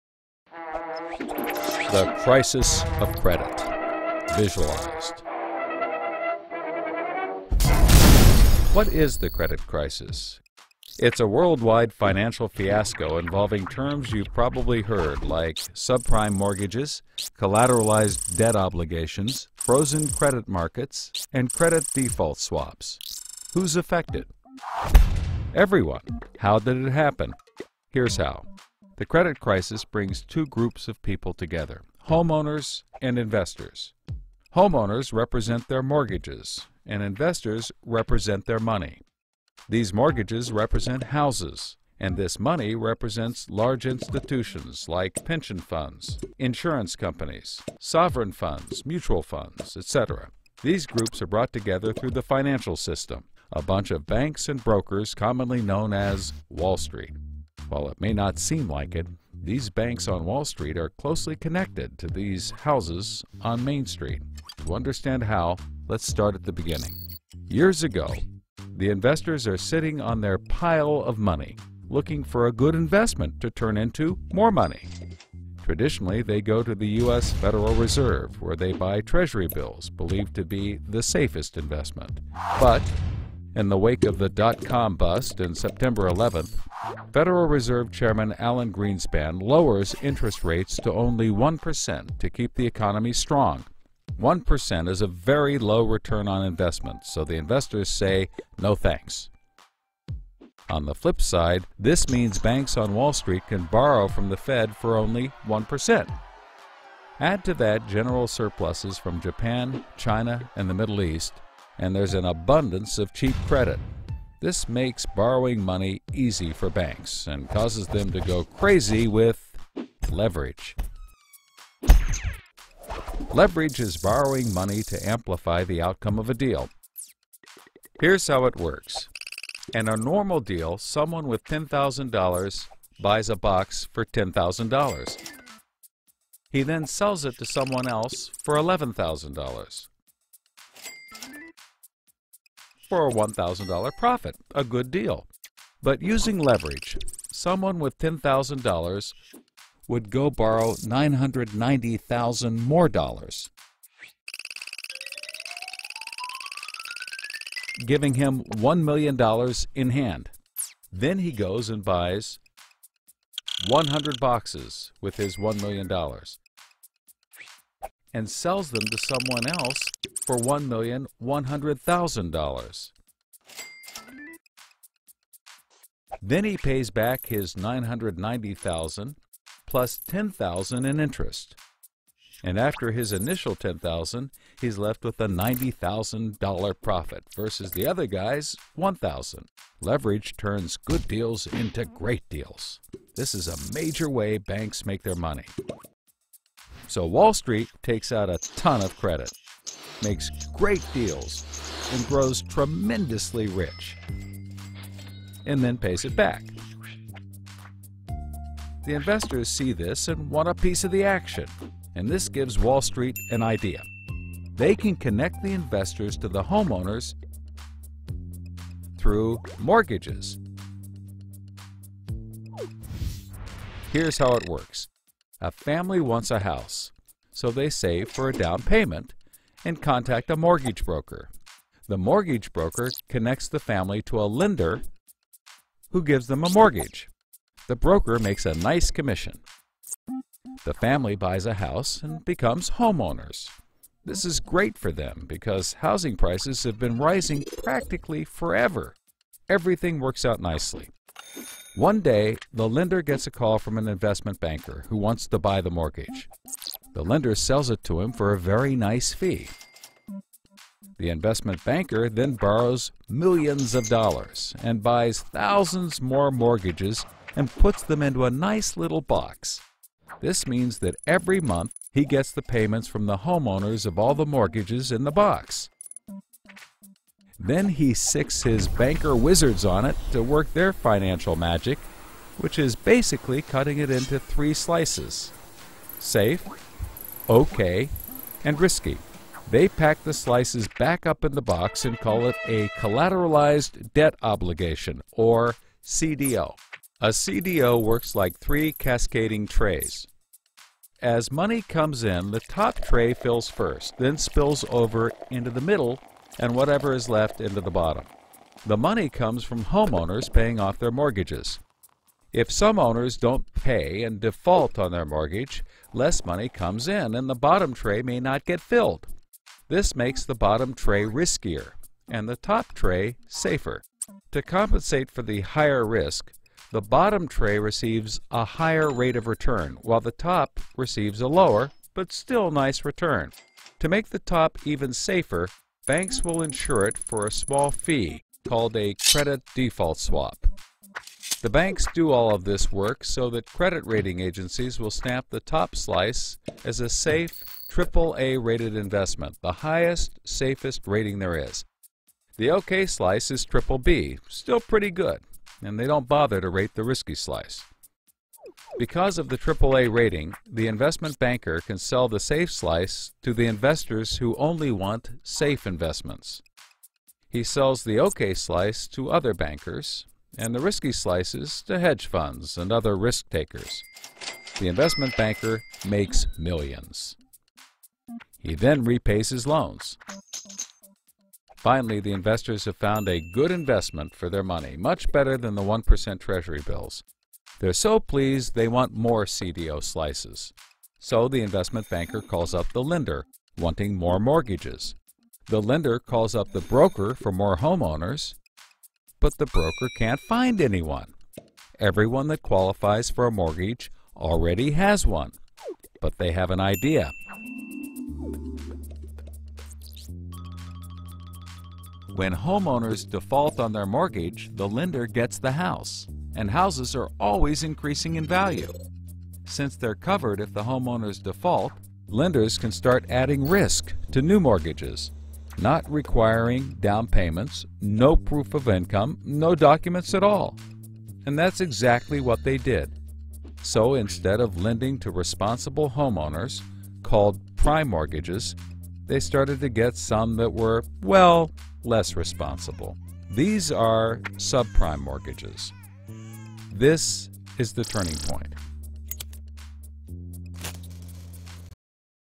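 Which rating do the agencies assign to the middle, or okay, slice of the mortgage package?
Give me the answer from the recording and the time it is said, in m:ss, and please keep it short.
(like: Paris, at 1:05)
triple B, at 5:53.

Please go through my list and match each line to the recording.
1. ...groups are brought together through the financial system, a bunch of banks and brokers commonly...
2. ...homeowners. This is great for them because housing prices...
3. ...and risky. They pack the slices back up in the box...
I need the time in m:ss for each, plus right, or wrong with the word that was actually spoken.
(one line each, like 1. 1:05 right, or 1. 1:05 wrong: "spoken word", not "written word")
1. 0:50 right
2. 4:02 right
3. 4:48 right.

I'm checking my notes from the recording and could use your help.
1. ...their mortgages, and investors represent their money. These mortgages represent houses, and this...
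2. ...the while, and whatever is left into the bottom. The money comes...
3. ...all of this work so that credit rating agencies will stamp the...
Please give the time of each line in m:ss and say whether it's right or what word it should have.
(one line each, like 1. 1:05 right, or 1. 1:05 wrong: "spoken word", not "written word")
1. 0:35 right
2. 5:05 wrong: "middle", not "while"
3. 5:42 right.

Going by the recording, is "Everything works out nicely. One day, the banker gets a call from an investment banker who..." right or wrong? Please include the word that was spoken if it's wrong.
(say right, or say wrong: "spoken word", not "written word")
wrong: "lender", not "banker".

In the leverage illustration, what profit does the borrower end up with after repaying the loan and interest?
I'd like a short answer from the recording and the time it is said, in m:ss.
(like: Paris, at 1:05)
$90,000, at 3:05.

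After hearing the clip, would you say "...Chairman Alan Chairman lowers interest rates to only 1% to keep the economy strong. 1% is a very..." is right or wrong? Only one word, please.
wrong.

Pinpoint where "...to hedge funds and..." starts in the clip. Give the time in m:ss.
6:11.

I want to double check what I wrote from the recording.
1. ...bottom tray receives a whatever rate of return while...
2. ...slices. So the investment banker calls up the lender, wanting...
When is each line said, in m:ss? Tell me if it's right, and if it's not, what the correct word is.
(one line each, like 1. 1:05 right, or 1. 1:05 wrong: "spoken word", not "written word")
1. 5:26 wrong: "higher", not "whatever"
2. 6:29 right.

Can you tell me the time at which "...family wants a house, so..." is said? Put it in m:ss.
3:45.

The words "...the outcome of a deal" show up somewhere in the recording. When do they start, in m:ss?
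2:05.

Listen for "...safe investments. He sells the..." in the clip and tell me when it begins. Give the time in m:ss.
6:05.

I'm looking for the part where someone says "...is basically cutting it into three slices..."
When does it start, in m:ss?
4:42.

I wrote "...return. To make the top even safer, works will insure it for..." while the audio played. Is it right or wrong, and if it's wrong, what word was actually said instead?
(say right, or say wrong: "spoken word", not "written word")
wrong: "banks", not "works".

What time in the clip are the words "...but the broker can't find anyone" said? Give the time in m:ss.
6:39.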